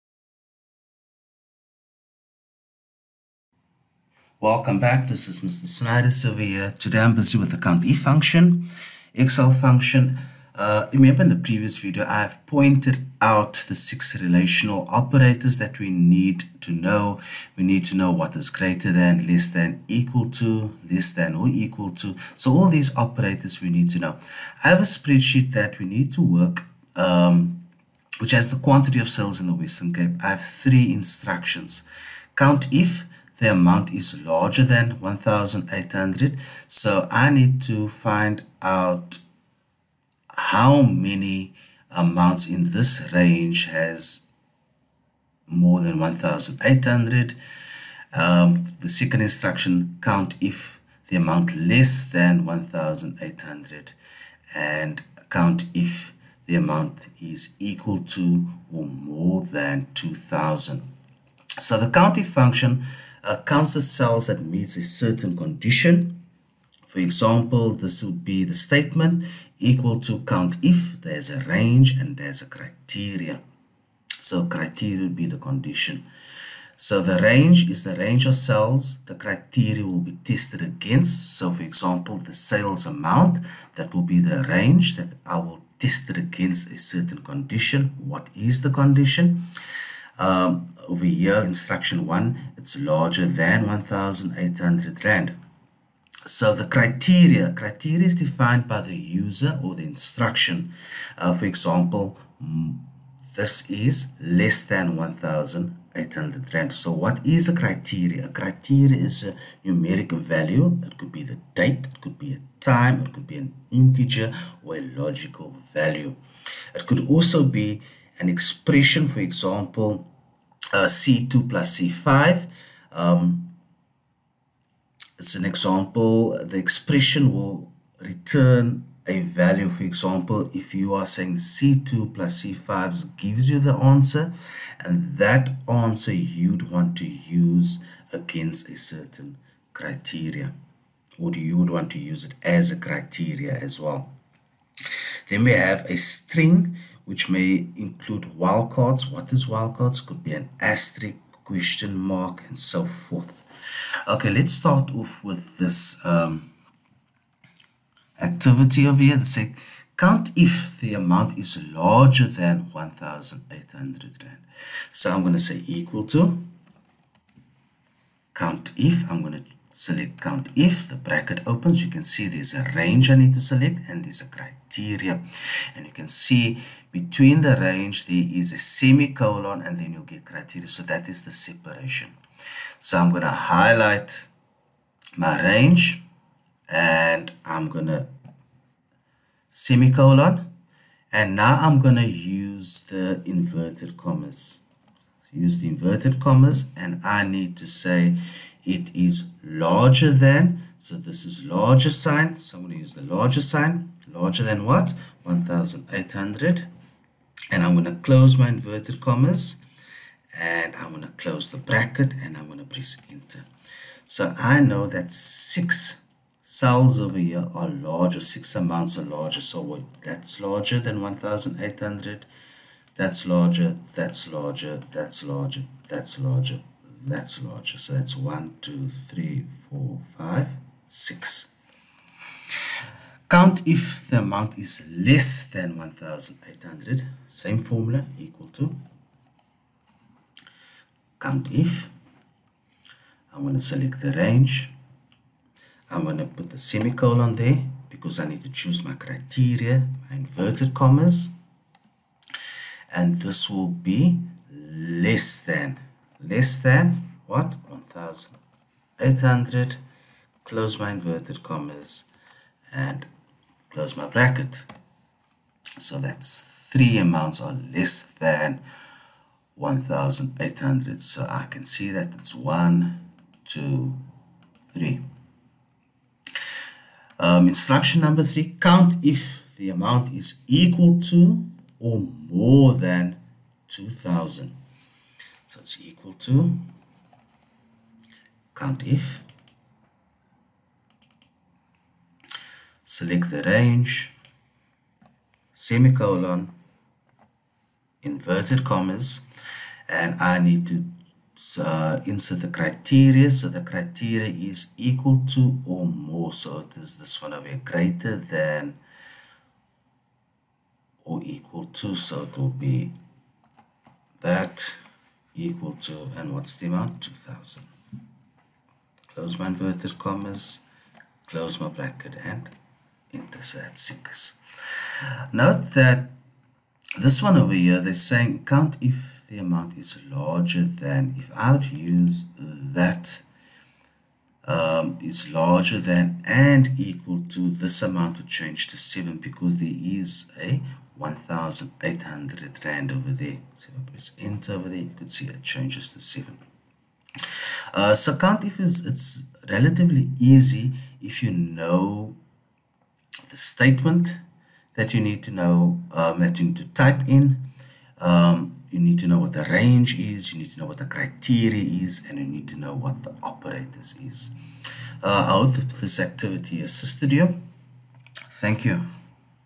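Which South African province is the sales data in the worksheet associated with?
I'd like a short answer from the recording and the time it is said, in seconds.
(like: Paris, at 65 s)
Western Cape, at 29 s.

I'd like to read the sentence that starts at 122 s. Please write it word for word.
Um, it's an example, the expression will return a value.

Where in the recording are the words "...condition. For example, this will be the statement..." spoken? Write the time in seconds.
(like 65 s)
65 s.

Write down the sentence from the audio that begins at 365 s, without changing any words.
Uh, I hope this activity assisted you.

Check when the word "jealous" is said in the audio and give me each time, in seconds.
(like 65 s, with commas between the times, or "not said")
not said.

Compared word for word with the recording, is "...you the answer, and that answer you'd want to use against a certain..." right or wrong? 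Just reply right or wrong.
right.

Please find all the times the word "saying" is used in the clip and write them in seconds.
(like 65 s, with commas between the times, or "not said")
131 s, 327 s.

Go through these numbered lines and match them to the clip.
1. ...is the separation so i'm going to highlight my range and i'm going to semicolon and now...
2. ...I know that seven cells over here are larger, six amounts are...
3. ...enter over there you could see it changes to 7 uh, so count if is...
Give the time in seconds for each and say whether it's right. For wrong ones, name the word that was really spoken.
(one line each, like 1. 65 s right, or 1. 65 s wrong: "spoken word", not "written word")
1. 181 s right
2. 214 s wrong: "six", not "seven"
3. 344 s right.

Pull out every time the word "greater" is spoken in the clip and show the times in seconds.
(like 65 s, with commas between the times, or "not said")
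18 s, 307 s.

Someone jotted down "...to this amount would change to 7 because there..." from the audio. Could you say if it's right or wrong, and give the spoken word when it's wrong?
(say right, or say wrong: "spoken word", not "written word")
right.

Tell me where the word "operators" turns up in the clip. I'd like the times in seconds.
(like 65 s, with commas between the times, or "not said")
14 s, 22 s, 363 s.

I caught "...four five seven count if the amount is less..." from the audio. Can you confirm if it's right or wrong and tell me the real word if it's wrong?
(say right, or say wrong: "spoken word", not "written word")
wrong: "six", not "seven".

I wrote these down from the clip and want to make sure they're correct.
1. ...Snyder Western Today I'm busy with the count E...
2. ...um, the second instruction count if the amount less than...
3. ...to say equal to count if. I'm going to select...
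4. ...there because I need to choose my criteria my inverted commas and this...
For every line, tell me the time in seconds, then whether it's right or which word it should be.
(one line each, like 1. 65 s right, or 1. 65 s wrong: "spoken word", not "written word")
1. 5 s wrong: "Silva", not "Western"
2. 48 s right
3. 165 s right
4. 247 s right.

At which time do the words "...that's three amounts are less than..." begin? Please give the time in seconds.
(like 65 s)
265 s.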